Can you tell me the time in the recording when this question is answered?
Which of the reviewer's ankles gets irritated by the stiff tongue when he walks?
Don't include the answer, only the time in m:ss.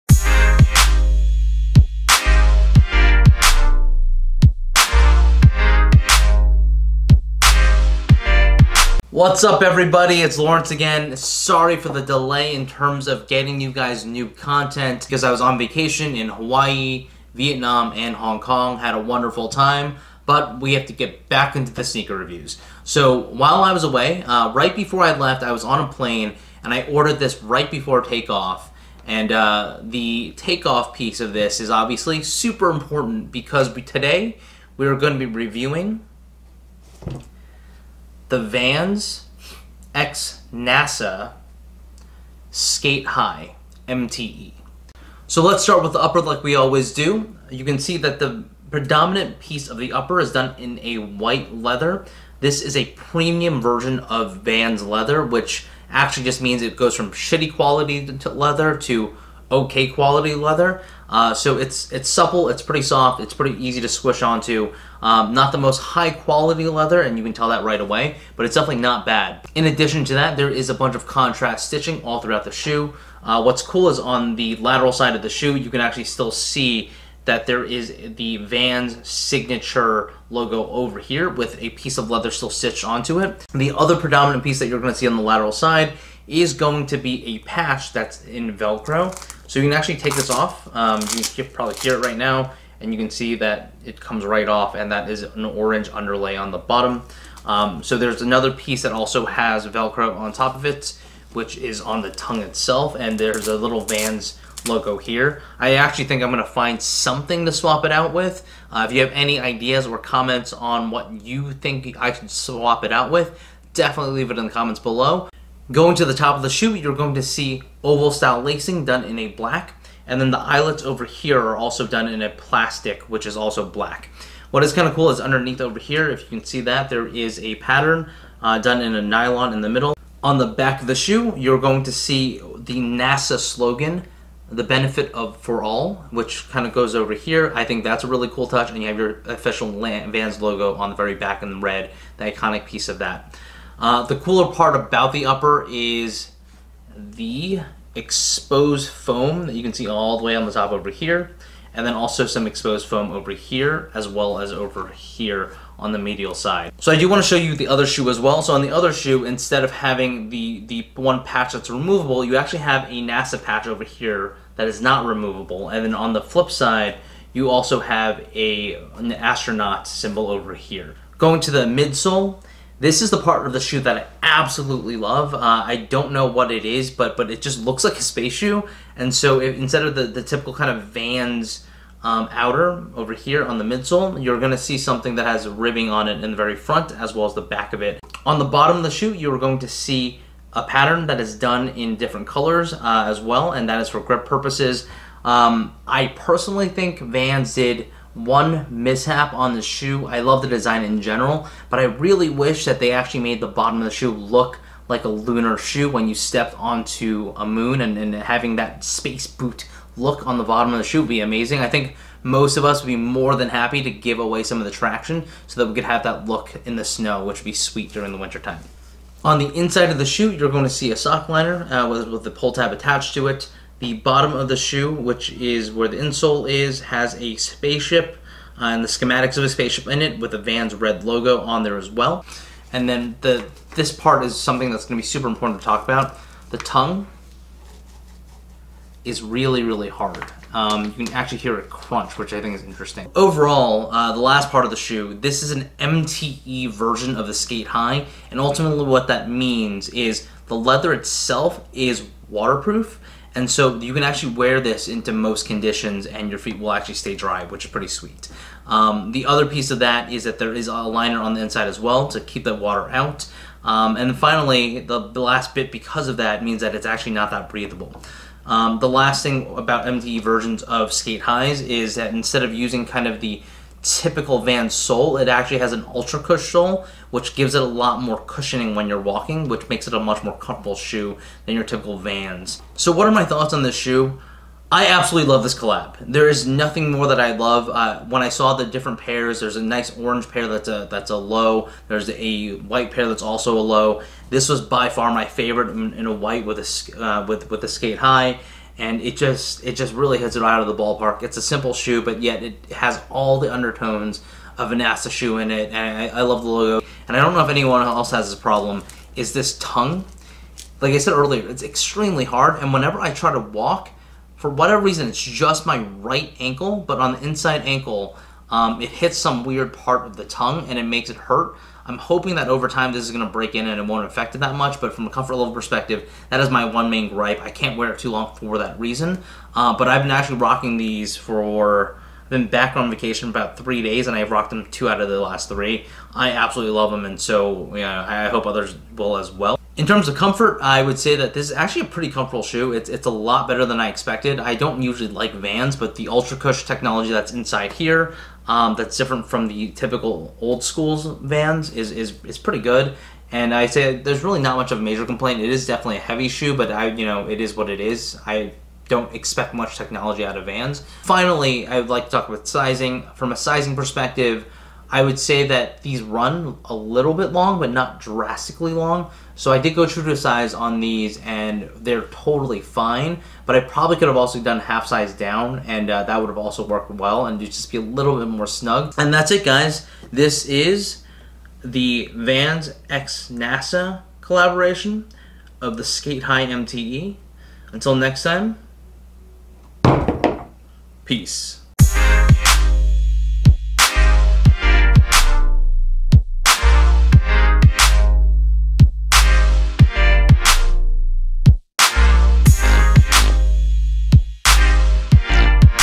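5:15.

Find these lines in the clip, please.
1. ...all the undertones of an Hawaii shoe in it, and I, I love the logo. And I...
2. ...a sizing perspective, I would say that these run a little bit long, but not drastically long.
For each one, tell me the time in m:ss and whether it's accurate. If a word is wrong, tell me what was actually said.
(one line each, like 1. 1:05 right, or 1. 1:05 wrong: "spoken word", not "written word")
1. 5:03 wrong: "NASA", not "Hawaii"
2. 6:03 right.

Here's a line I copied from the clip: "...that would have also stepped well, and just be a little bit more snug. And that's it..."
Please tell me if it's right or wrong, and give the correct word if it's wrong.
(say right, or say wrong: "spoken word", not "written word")
wrong: "worked", not "stepped".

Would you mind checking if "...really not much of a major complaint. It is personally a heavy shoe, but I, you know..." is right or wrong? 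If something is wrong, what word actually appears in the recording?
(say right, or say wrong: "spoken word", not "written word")
wrong: "definitely", not "personally".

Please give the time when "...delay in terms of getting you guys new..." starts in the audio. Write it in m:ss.
0:12.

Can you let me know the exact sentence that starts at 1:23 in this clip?
The other predominant piece that you're going to see on the lateral side is going to be a patch that's in Velcro.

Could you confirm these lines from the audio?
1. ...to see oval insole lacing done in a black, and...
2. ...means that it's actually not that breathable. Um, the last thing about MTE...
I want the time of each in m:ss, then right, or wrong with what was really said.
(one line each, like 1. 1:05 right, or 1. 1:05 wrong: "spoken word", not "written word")
1. 1:57 wrong: "style", not "insole"
2. 4:26 right.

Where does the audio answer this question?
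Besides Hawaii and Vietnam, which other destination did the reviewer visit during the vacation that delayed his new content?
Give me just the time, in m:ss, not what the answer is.
0:18.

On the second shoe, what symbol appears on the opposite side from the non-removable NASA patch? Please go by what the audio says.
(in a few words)
An astronaut.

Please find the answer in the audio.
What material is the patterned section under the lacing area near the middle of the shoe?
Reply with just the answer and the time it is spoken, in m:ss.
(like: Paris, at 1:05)
Nylon, at 2:09.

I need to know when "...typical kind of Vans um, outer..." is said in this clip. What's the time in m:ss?
3:00.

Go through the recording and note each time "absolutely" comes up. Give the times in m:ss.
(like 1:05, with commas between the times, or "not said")
2:54, 4:44, 5:36.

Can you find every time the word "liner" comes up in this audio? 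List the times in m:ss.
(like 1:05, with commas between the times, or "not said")
3:41, 4:20.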